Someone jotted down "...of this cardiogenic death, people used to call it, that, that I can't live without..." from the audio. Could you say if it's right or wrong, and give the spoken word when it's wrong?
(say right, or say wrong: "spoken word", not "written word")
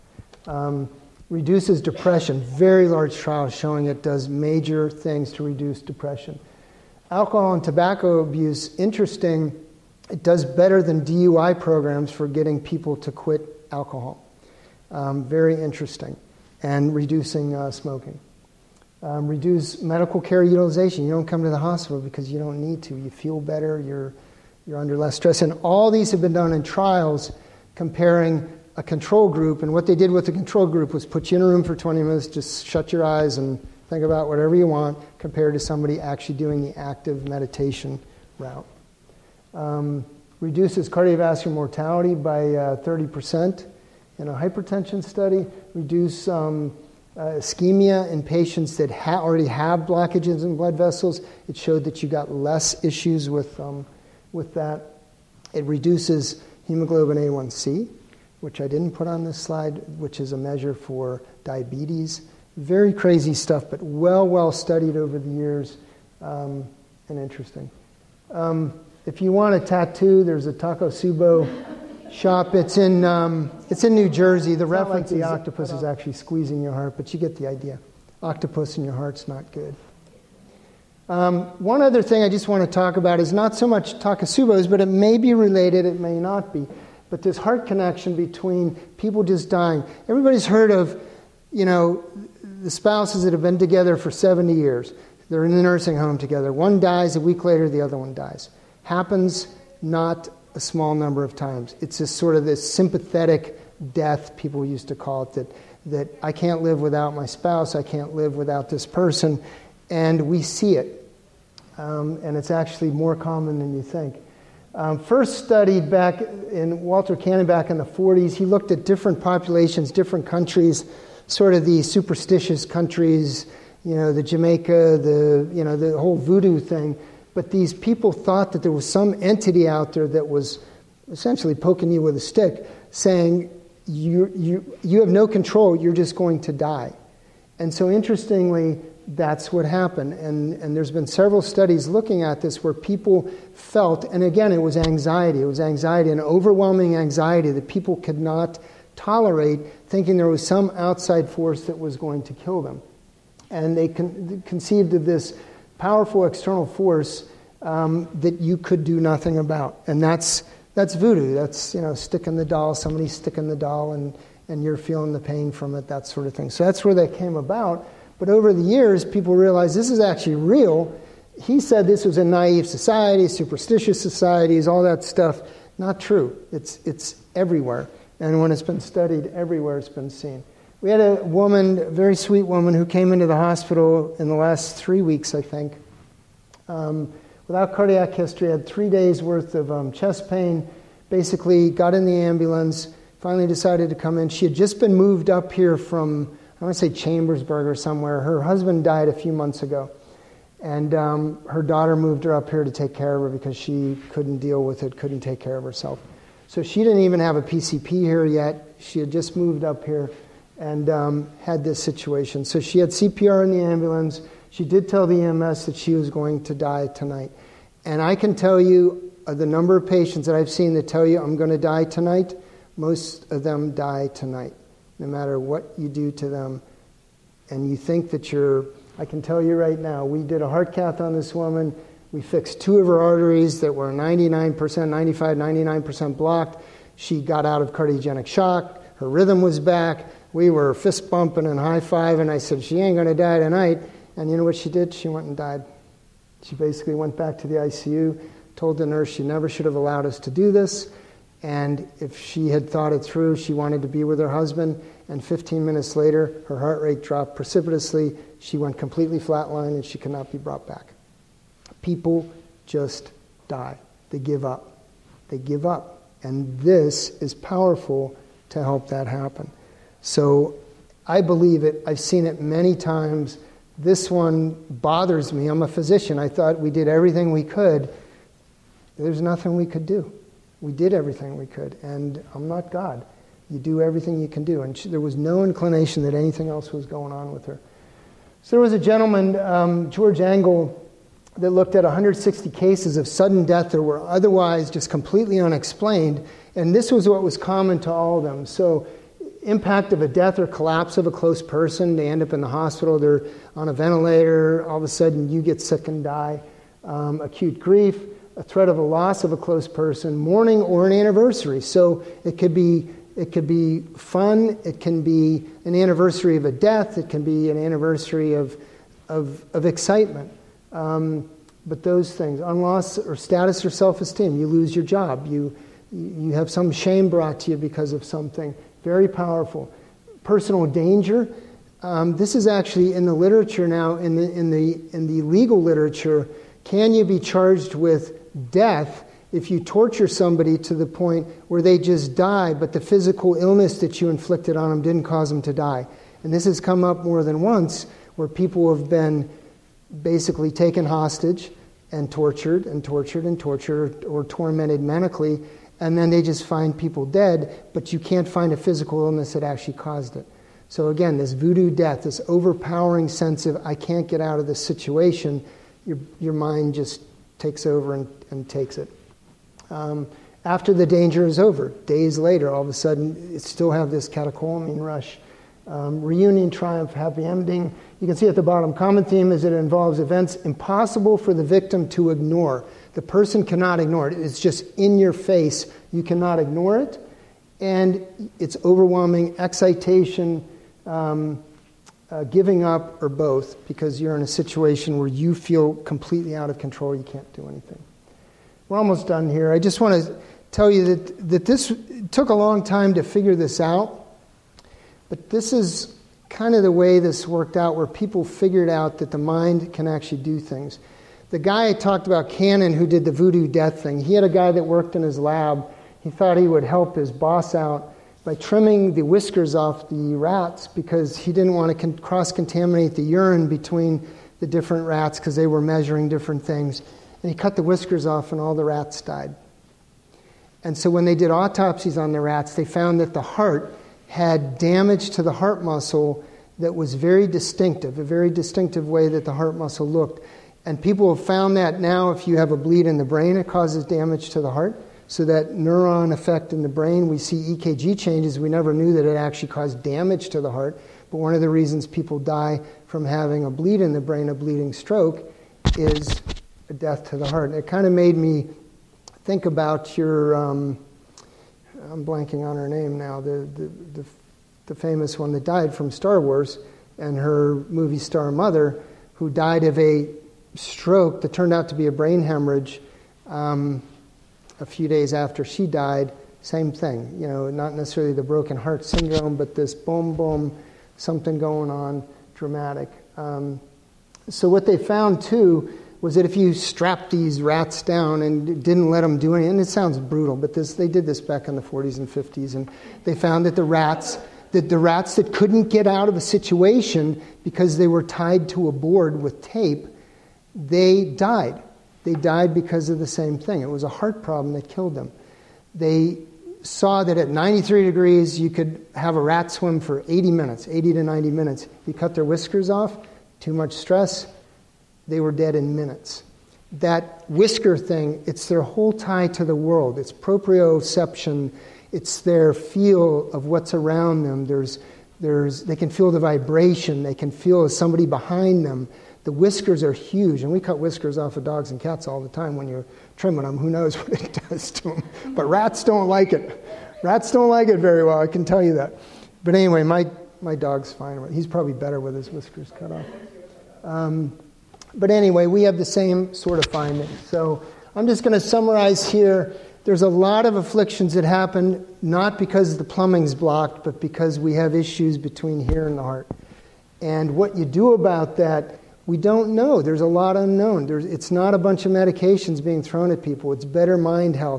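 wrong: "sympathetic", not "cardiogenic".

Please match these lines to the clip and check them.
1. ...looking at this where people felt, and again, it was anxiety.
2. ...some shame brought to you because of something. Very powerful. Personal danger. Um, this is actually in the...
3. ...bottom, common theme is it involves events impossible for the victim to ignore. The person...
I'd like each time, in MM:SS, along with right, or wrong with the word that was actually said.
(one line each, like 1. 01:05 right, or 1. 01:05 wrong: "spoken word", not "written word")
1. 02:21 right
2. 05:26 right
3. 06:18 right.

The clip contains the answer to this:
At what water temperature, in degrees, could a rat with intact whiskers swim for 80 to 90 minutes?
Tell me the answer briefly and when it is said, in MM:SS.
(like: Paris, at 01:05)
93, at 08:27.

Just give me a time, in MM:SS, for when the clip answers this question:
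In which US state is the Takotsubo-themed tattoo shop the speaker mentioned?
01:13.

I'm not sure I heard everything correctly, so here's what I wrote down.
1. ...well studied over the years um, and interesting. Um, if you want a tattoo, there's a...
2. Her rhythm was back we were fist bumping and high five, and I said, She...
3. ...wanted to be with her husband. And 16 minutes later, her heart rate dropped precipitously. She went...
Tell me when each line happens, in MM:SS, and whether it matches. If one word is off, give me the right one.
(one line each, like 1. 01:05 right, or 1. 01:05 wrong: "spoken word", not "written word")
1. 01:04 right
2. 03:58 right
3. 04:13 wrong: "15", not "16".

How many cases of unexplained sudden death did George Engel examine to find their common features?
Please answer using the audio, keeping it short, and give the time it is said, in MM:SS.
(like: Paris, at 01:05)
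160, at 04:51.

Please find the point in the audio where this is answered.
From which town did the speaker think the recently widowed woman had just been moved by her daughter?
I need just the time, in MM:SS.
03:16.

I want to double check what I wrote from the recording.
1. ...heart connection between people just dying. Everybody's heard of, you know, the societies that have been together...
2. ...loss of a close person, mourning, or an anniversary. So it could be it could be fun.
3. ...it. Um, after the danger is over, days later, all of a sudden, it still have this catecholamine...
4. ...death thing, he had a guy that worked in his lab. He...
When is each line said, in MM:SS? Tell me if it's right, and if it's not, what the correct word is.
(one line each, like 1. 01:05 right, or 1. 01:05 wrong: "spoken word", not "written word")
1. 01:27 wrong: "spouses", not "societies"
2. 05:08 right
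3. 06:08 right
4. 06:53 right.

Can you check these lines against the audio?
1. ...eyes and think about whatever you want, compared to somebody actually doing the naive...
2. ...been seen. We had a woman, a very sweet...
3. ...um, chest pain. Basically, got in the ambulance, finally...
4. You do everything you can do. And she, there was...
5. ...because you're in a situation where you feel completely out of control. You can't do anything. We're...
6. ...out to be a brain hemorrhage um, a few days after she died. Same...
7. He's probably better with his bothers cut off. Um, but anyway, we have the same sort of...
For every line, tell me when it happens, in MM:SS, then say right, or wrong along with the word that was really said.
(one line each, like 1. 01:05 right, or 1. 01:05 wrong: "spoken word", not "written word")
1. 00:33 wrong: "active", not "naive"
2. 02:59 right
3. 03:09 right
4. 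04:43 right
5. 06:33 right
6. 07:51 right
7. 09:01 wrong: "whiskers", not "bothers".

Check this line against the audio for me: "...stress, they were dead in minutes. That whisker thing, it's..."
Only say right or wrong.
right.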